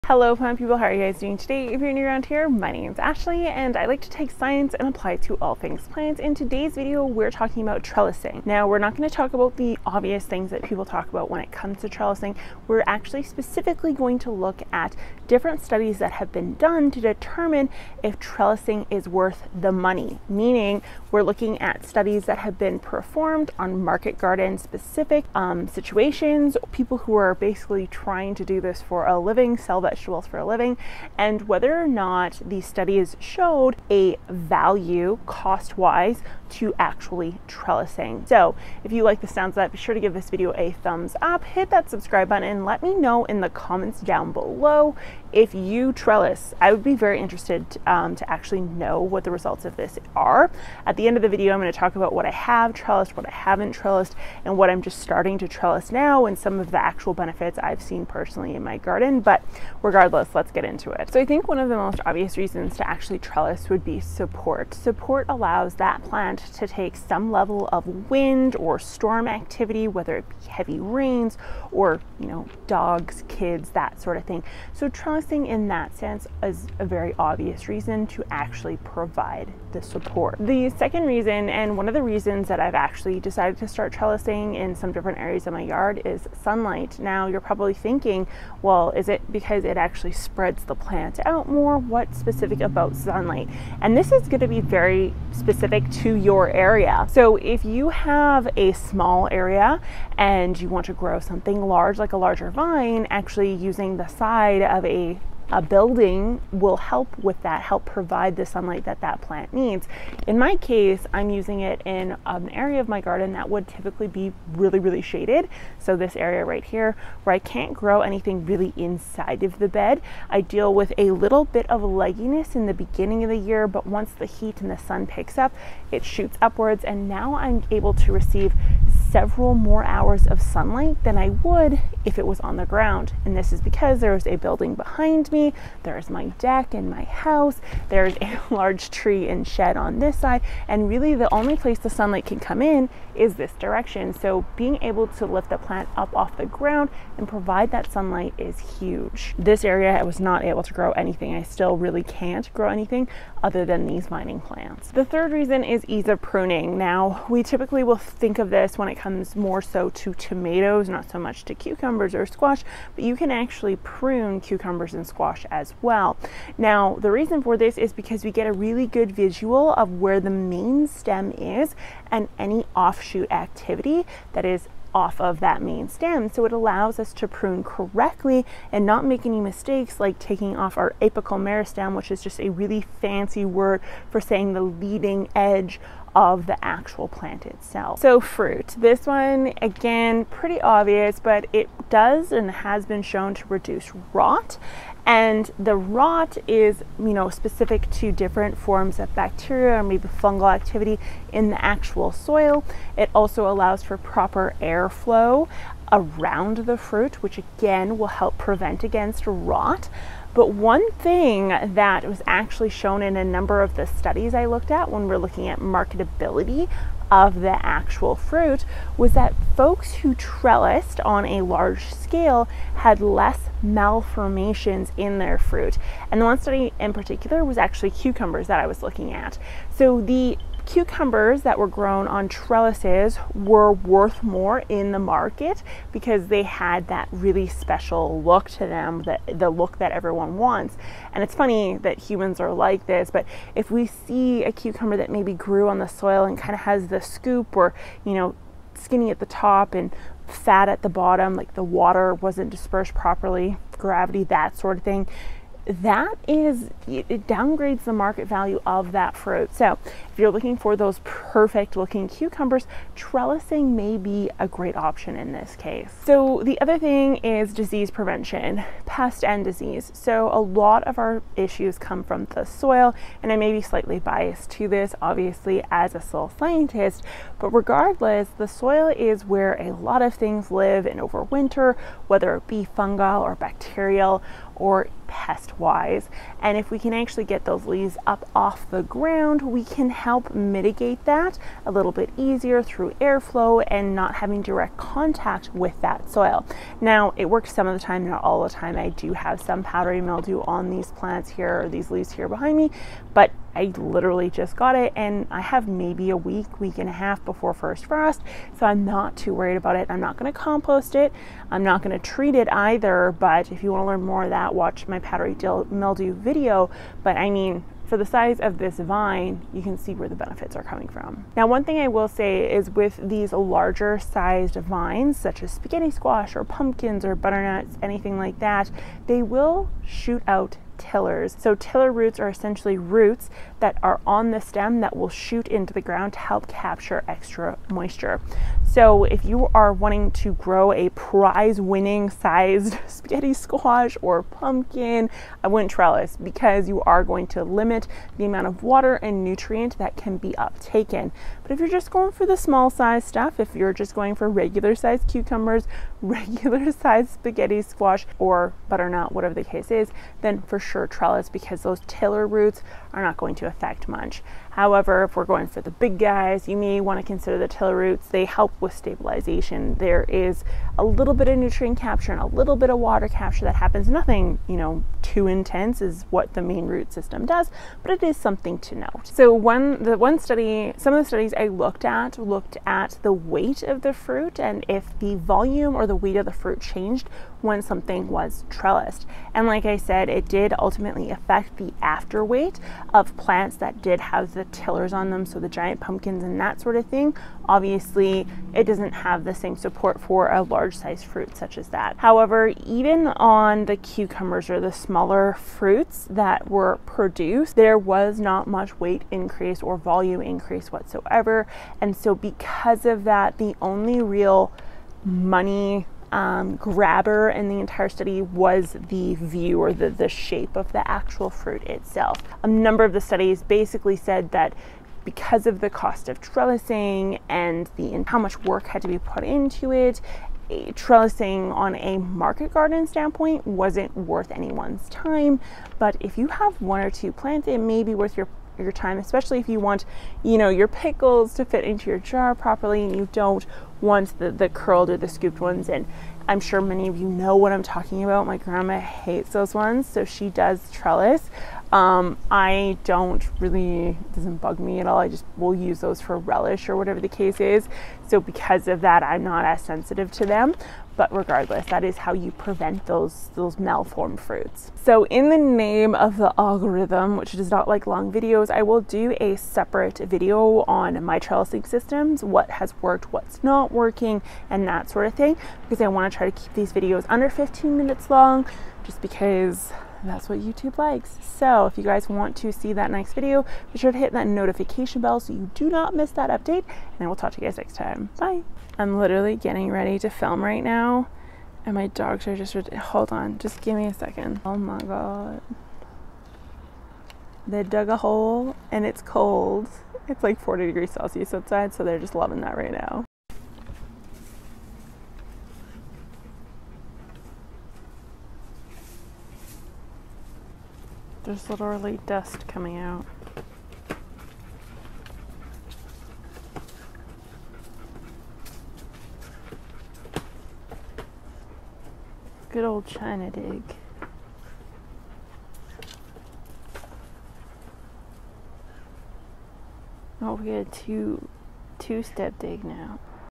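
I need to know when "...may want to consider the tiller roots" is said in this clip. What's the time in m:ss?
6:06.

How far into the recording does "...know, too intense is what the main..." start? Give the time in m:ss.
6:14.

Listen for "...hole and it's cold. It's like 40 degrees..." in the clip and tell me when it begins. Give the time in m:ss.
8:17.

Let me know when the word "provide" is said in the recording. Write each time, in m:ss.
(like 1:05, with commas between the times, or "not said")
1:18, 1:47, 2:27.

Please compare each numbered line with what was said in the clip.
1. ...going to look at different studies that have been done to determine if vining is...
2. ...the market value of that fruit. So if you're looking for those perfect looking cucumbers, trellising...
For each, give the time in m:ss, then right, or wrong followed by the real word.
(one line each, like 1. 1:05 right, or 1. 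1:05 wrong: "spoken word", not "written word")
1. 0:13 wrong: "trellising", not "vining"
2. 4:17 right.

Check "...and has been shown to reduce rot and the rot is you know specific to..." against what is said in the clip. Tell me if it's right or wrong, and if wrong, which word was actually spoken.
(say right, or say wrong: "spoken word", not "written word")
right.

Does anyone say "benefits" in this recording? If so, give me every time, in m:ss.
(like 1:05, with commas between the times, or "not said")
0:57, 5:20.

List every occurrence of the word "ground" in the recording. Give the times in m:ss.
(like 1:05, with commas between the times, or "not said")
2:12, 2:26, 4:48, 5:35.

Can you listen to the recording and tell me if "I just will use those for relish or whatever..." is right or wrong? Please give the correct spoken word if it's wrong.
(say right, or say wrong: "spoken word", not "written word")
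right.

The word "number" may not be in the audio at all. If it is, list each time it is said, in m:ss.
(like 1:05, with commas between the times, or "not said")
3:33, 7:02.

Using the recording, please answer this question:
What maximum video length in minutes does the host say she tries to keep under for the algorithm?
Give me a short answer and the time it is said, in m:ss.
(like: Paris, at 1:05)
15 minutes, at 7:57.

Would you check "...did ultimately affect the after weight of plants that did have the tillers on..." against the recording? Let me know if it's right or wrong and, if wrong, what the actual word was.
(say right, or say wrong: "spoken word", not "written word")
right.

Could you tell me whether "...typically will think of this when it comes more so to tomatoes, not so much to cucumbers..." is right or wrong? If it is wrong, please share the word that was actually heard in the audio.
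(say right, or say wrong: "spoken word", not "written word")
right.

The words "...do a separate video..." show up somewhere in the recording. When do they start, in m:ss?
7:48.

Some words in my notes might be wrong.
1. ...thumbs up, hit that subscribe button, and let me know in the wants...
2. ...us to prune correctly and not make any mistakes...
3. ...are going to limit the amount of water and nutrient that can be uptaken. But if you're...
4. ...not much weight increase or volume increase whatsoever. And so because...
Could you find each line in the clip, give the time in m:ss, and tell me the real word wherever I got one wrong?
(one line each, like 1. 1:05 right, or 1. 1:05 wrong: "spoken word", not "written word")
1. 0:40 wrong: "comments", not "wants"
2. 2:56 right
3. 5:46 right
4. 6:48 right.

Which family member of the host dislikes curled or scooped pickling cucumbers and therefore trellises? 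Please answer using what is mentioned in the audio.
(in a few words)
grandma.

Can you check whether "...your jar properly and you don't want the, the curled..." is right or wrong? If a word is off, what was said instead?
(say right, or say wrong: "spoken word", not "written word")
right.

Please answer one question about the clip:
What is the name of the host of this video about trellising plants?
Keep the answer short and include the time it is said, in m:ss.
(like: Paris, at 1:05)
Ashley, at 0:02.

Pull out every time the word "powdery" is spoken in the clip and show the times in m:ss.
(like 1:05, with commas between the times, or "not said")
4:59, 5:14.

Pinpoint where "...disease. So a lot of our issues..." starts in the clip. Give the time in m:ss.
4:29.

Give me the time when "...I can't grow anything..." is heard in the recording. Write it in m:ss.
1:57.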